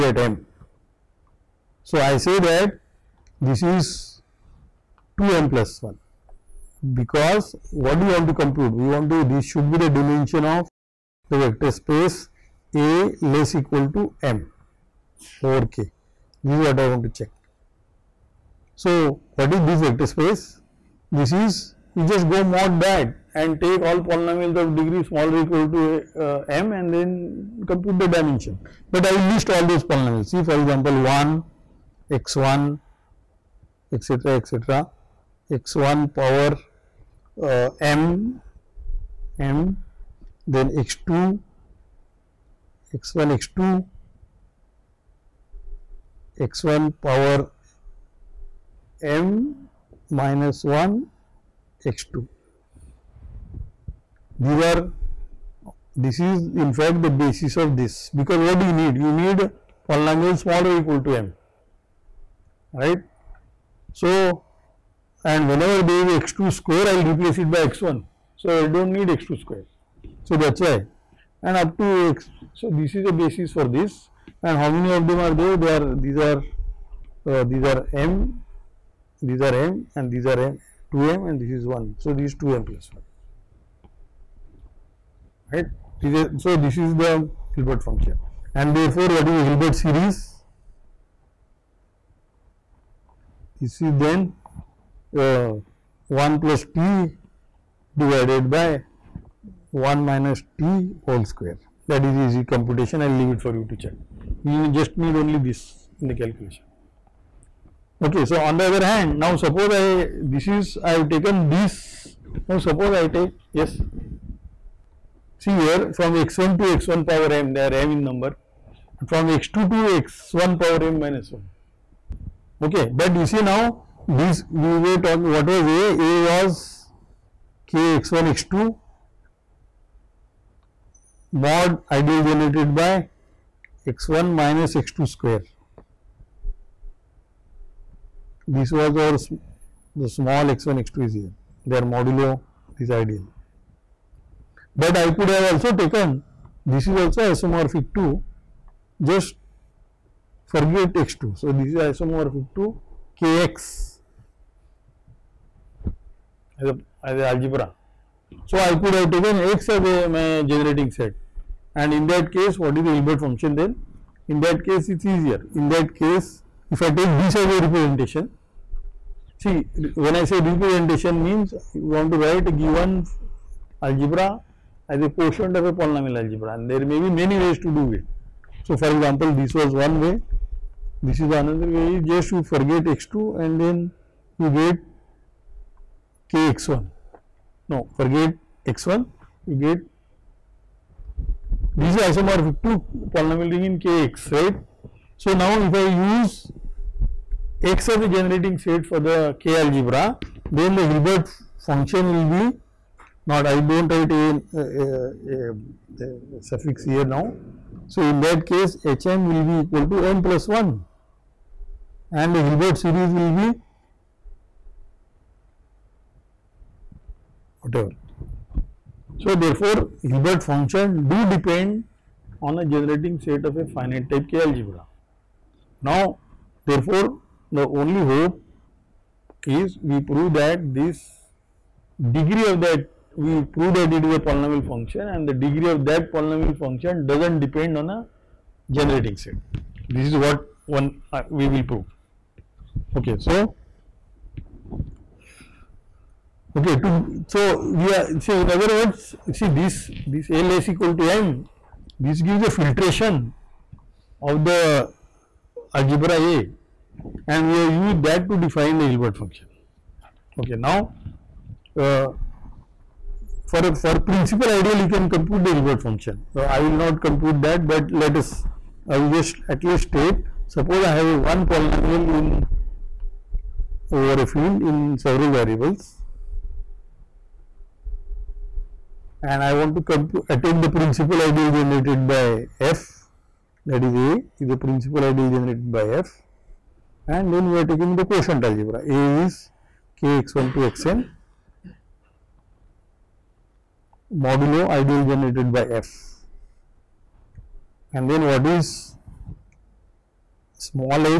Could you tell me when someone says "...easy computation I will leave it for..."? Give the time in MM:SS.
01:42.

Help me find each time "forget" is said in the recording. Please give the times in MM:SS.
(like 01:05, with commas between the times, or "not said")
02:30, 03:02, 03:07.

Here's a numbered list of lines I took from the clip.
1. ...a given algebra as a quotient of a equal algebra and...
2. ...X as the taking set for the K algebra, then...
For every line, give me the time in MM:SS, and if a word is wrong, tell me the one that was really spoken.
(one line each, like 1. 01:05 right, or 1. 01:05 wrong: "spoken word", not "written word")
1. 02:52 wrong: "polynomial", not "equal"
2. 03:17 wrong: "generating", not "taking".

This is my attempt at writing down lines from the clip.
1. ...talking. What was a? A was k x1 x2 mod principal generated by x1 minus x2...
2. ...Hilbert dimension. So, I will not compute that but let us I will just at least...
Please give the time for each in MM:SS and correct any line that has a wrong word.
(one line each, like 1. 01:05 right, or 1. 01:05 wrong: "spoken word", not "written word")
1. 02:04 wrong: "ideal", not "principal"
2. 04:25 wrong: "function", not "dimension".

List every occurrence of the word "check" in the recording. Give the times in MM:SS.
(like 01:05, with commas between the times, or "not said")
00:17, 01:43.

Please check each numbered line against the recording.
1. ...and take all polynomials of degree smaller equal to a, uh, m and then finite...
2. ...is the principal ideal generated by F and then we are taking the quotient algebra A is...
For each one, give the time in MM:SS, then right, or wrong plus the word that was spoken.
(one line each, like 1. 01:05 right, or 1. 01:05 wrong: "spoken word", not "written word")
1. 00:23 wrong: "compute", not "finite"
2. 04:44 right.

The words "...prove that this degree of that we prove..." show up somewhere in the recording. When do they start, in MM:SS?
03:50.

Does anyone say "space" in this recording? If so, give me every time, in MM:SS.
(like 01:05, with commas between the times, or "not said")
00:11, 00:20.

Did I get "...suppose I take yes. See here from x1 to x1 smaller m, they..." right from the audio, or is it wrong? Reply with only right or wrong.
wrong.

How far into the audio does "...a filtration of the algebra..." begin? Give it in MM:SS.
04:12.